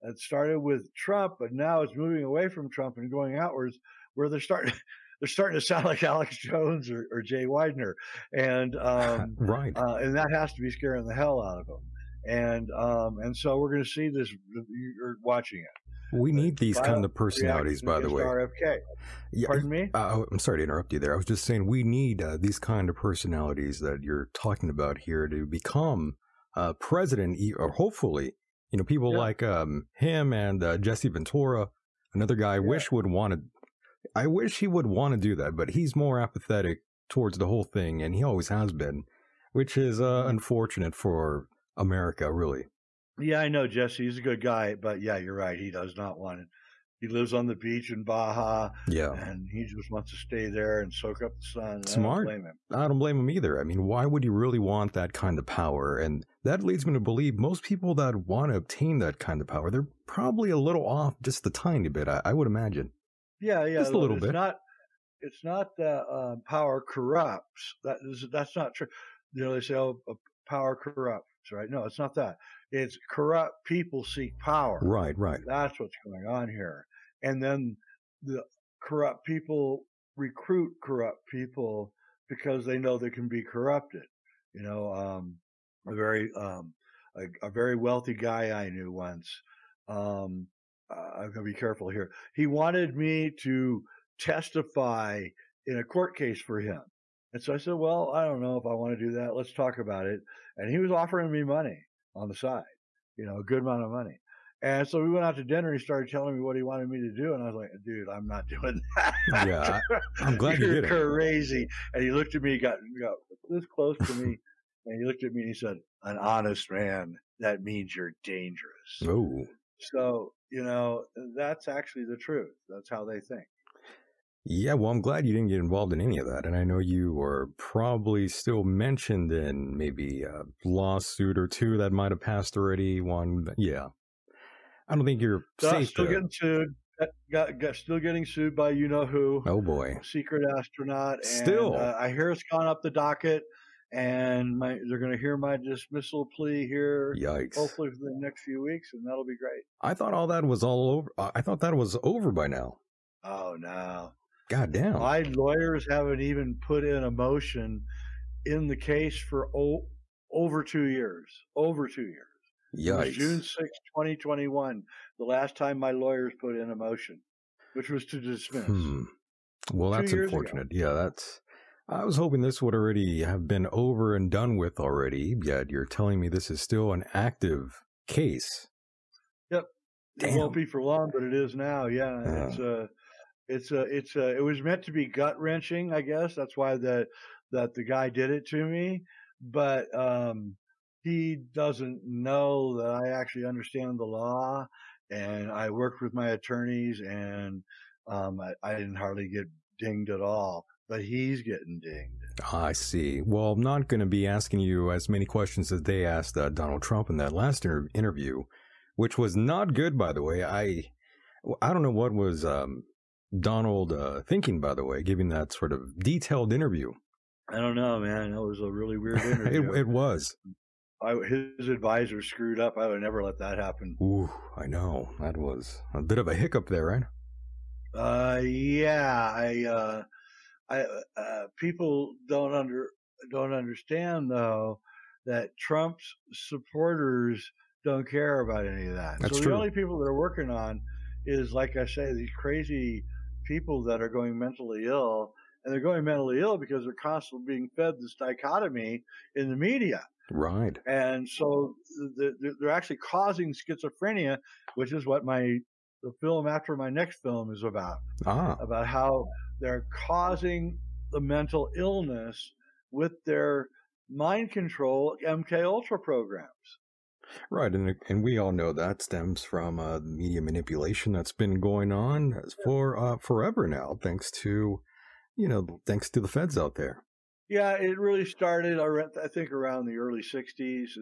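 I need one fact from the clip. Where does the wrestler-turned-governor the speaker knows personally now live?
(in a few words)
Baja.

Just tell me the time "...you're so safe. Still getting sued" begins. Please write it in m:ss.
2:15.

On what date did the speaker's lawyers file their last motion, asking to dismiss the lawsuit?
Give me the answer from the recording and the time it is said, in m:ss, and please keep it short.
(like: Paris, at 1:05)
June 6, 2021, at 2:43.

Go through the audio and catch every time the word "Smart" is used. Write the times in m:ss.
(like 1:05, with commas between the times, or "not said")
0:51.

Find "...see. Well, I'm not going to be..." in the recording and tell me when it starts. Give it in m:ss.
3:22.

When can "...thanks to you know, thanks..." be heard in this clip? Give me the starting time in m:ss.
4:34.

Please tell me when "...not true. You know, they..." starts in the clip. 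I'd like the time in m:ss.
1:08.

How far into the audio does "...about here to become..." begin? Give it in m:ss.
0:24.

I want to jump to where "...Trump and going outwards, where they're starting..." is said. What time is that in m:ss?
0:02.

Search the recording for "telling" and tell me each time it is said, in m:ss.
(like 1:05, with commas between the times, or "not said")
1:46, 2:55.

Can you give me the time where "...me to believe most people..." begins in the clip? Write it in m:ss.
0:56.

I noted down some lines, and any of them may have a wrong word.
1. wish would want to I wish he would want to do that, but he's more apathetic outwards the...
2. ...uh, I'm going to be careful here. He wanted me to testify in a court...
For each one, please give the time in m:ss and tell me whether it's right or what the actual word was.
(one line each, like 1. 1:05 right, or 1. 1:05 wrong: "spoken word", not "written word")
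1. 0:32 wrong: "towards", not "outwards"
2. 1:30 right.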